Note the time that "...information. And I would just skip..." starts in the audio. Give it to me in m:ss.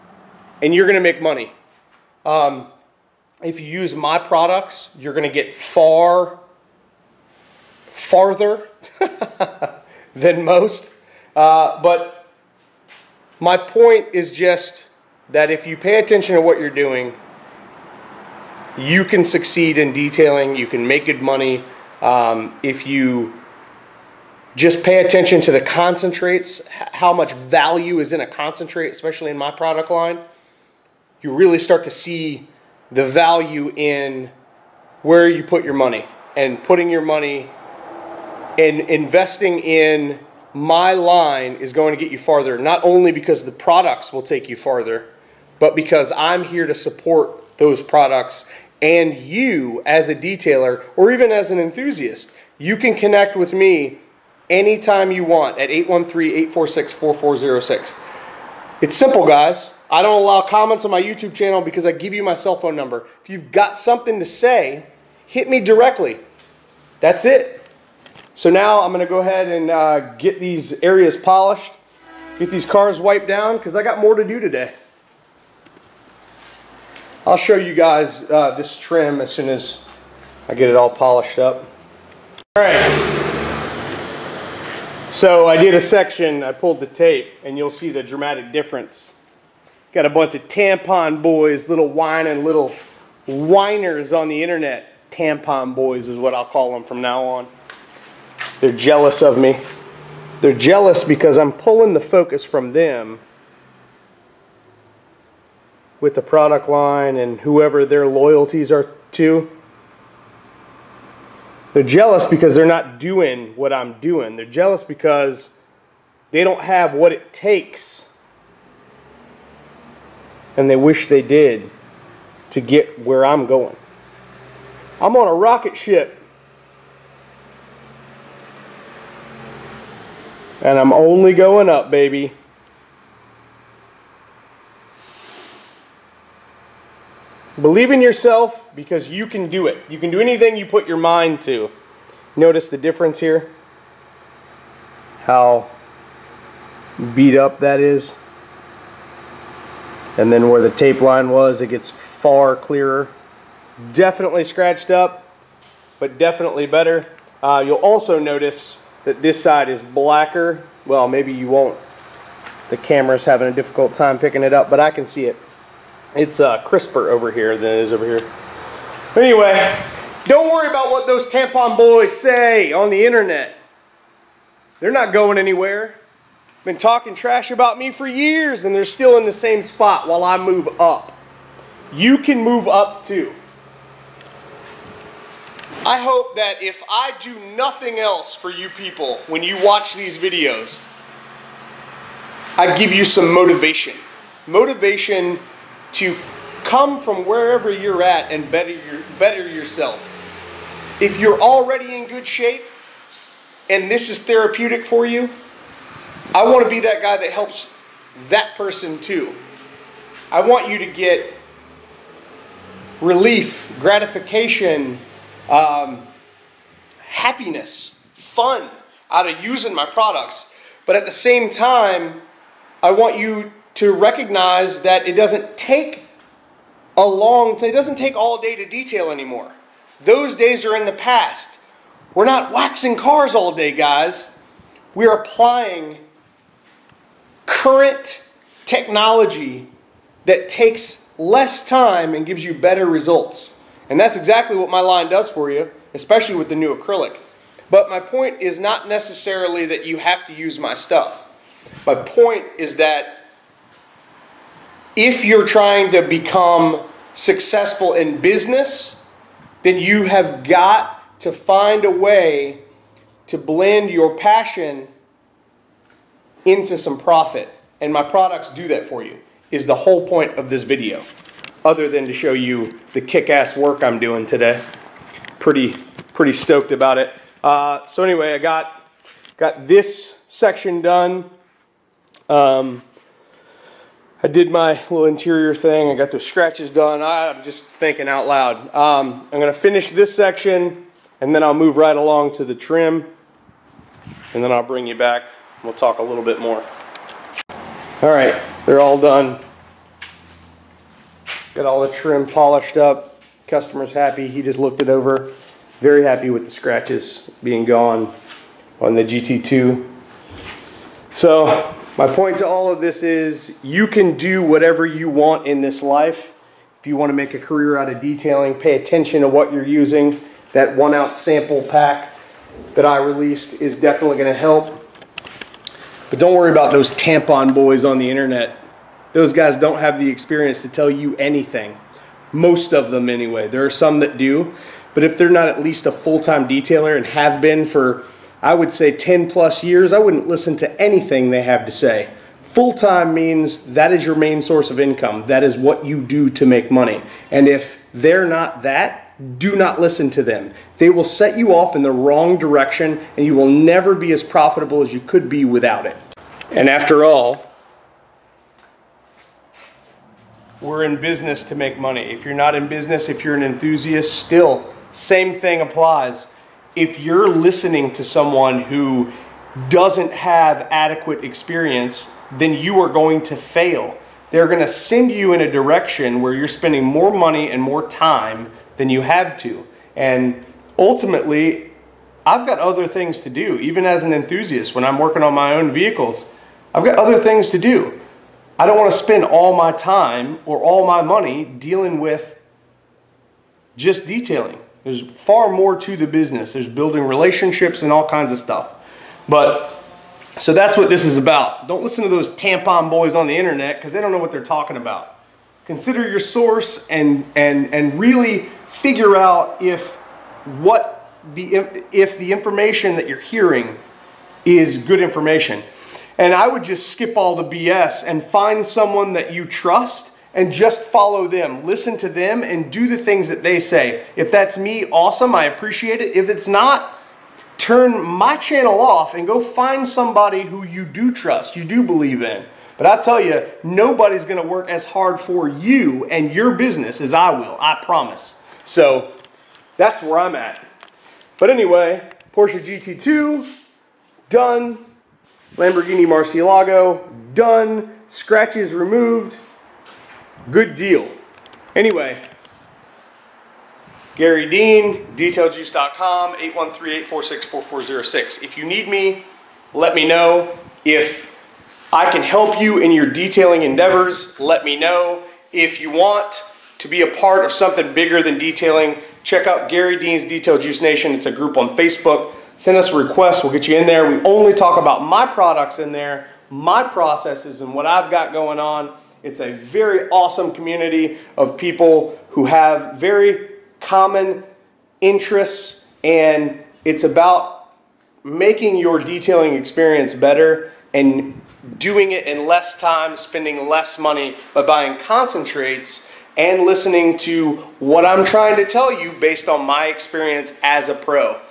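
6:55.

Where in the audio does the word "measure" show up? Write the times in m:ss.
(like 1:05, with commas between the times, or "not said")
not said.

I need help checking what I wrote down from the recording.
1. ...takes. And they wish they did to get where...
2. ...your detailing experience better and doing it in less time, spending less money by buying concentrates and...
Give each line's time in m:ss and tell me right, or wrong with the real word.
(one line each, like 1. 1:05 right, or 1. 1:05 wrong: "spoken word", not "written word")
1. 1:57 right
2. 8:08 right.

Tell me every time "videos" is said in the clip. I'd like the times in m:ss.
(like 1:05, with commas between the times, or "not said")
3:10, 4:30.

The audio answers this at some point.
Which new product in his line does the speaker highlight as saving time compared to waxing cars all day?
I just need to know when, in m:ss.
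4:06.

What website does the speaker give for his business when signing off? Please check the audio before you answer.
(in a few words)
detailjuice.com.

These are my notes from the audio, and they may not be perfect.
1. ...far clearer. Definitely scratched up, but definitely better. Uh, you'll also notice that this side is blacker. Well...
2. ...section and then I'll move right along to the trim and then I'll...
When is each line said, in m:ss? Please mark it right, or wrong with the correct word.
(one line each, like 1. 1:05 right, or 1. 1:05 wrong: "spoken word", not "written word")
1. 2:31 right
2. 4:50 right.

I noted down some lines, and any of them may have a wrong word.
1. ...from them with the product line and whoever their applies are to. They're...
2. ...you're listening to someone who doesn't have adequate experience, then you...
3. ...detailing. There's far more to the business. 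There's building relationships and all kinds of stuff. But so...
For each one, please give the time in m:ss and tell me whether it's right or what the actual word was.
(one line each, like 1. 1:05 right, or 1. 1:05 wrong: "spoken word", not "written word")
1. 1:42 wrong: "loyalties", not "applies"
2. 6:06 right
3. 6:34 right.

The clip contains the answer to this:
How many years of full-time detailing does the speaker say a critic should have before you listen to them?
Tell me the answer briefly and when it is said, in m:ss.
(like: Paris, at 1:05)
10 plus years, at 5:38.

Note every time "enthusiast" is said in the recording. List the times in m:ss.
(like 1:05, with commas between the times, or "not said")
0:51, 6:03, 6:24.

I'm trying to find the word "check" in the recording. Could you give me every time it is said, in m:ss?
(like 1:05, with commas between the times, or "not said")
7:49.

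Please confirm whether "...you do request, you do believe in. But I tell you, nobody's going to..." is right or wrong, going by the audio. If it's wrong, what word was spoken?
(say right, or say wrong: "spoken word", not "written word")
wrong: "trust", not "request".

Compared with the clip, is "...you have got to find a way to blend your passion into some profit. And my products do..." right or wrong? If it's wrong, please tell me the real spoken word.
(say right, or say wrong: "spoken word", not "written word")
right.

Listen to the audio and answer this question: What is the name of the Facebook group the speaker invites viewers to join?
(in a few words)
Garry Dean's Detail Juice Nation.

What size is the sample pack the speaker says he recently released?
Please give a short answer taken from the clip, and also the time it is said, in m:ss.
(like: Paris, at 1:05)
One ounce, at 5:20.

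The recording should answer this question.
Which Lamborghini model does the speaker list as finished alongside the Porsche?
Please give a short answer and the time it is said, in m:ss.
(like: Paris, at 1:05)
Murcielago, at 7:25.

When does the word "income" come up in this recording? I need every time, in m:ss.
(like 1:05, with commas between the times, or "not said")
5:44.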